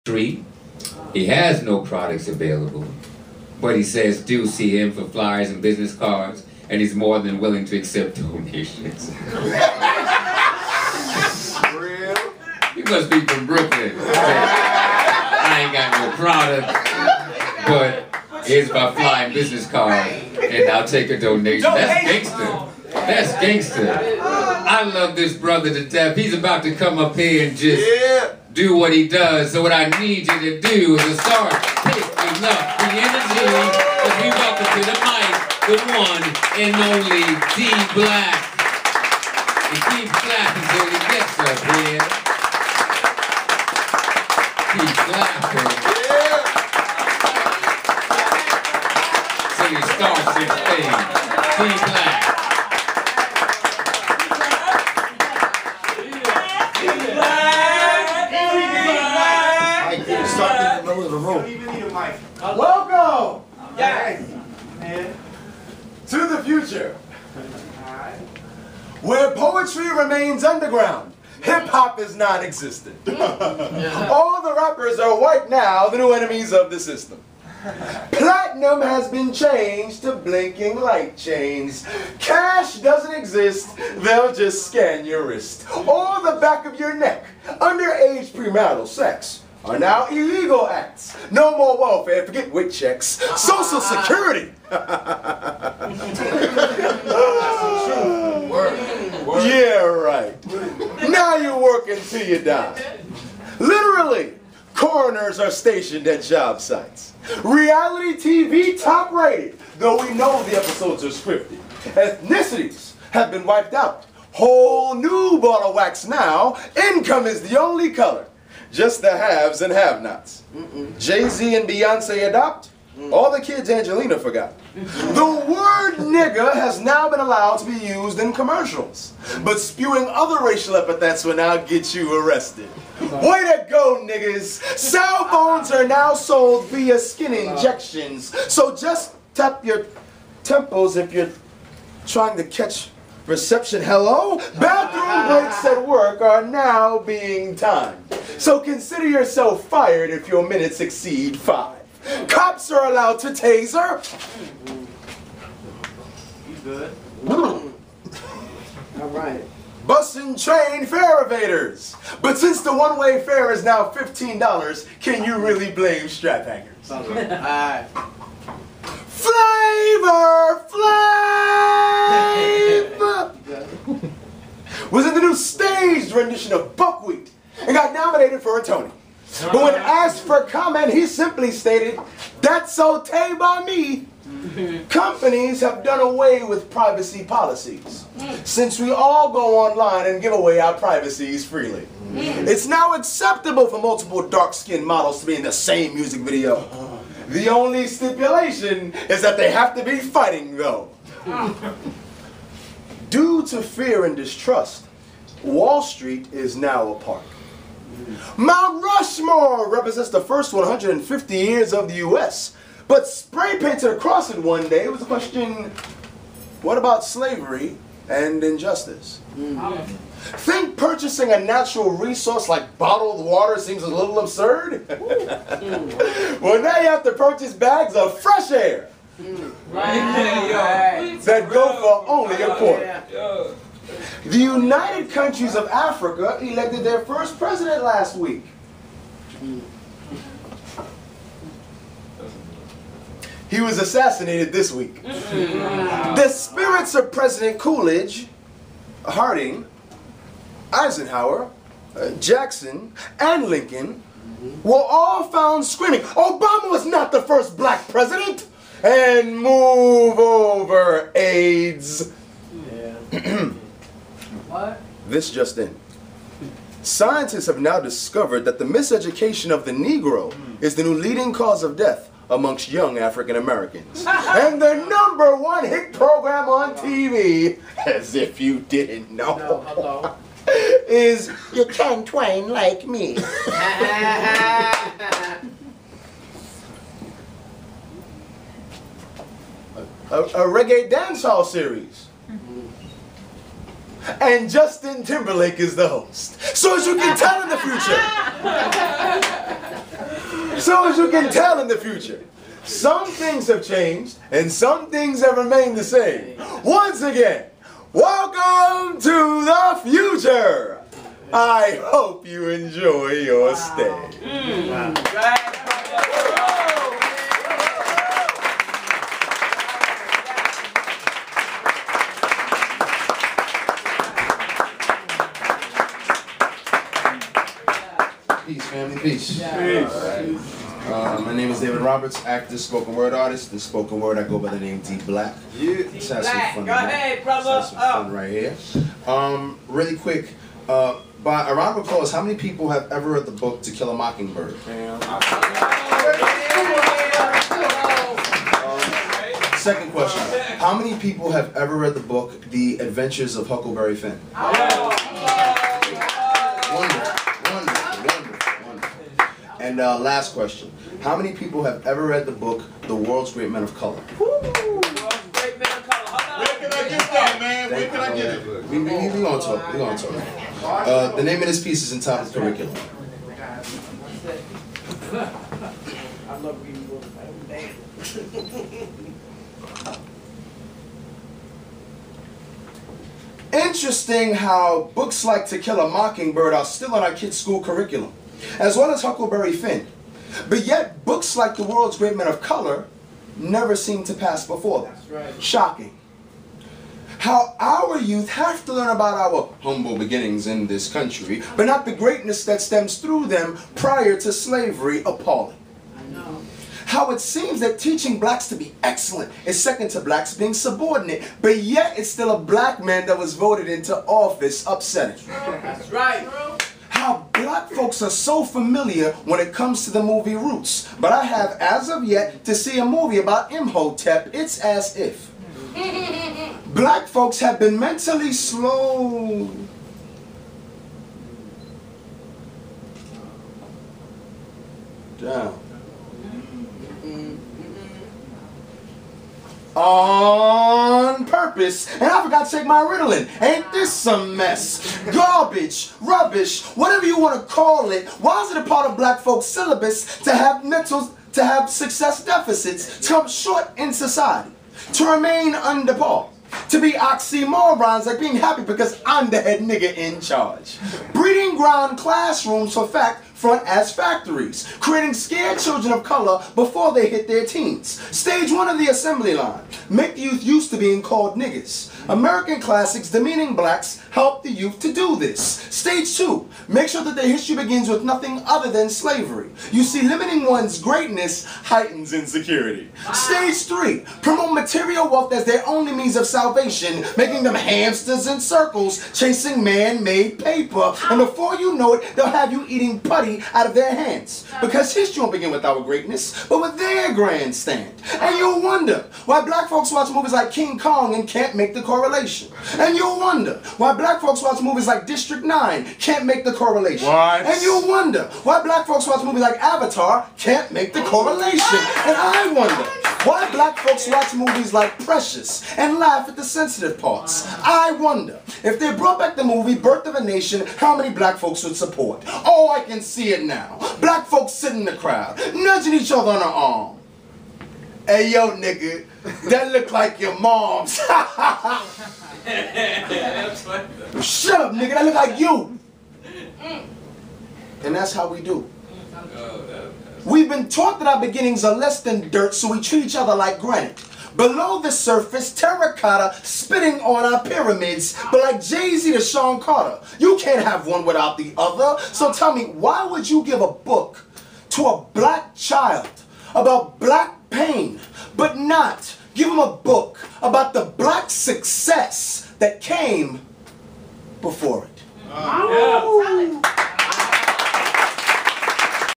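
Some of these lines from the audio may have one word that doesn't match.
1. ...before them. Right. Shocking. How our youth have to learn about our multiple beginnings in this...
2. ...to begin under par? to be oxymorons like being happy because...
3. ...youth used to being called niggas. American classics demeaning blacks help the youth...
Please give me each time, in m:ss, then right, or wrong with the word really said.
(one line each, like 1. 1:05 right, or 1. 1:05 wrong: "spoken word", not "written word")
1. 6:34 wrong: "humble", not "multiple"
2. 7:34 wrong: "remain", not "begin"
3. 7:50 right.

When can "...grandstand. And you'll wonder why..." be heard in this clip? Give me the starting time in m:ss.
8:17.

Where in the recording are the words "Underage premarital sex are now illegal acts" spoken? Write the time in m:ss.
1:27.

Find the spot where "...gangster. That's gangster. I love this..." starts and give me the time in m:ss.
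0:22.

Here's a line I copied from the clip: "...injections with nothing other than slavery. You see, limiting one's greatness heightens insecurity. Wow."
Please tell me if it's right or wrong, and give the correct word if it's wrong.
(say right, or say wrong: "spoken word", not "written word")
wrong: "begins", not "injections".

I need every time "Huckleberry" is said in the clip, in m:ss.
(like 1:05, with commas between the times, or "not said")
5:53, 6:29.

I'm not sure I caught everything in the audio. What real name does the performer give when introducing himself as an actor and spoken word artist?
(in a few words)
David Roberts.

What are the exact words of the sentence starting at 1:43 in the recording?
Literally, coroners are stationed at job sites.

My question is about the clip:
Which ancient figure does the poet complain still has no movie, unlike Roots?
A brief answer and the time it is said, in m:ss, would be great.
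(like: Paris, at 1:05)
Imhotep, at 7:03.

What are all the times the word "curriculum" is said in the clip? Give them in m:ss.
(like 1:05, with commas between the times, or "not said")
6:12, 6:27.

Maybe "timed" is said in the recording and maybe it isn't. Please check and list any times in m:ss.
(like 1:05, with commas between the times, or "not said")
2:27.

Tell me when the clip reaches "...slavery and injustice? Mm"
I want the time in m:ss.
3:37.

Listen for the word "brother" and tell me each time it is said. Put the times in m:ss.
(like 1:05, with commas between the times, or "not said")
0:25, 5:37.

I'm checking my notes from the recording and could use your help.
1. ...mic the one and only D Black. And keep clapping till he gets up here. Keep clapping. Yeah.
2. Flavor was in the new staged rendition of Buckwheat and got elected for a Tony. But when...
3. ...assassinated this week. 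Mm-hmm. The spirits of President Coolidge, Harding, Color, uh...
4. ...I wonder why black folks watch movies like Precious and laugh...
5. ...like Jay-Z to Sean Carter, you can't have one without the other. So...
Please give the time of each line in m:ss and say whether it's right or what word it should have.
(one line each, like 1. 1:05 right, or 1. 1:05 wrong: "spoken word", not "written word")
1. 0:34 right
2. 2:49 wrong: "nominated", not "elected"
3. 4:03 wrong: "Eisenhower", not "Color"
4. 8:32 right
5. 9:08 right.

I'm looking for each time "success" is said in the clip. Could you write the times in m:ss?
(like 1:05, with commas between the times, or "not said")
7:31, 9:21.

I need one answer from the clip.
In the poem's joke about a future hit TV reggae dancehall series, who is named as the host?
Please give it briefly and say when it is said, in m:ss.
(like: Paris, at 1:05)
Justin Timberlake, at 4:54.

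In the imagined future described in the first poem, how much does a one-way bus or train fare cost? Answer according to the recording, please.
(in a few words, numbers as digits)
$15.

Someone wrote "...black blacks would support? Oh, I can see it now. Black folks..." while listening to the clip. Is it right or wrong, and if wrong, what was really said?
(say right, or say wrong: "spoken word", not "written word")
wrong: "folks", not "blacks".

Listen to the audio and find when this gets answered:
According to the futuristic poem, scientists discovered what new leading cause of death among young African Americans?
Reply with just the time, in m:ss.
4:28.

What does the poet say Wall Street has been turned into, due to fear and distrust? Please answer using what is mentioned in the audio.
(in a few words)
A park.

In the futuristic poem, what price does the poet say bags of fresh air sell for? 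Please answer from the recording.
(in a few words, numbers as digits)
A quarter.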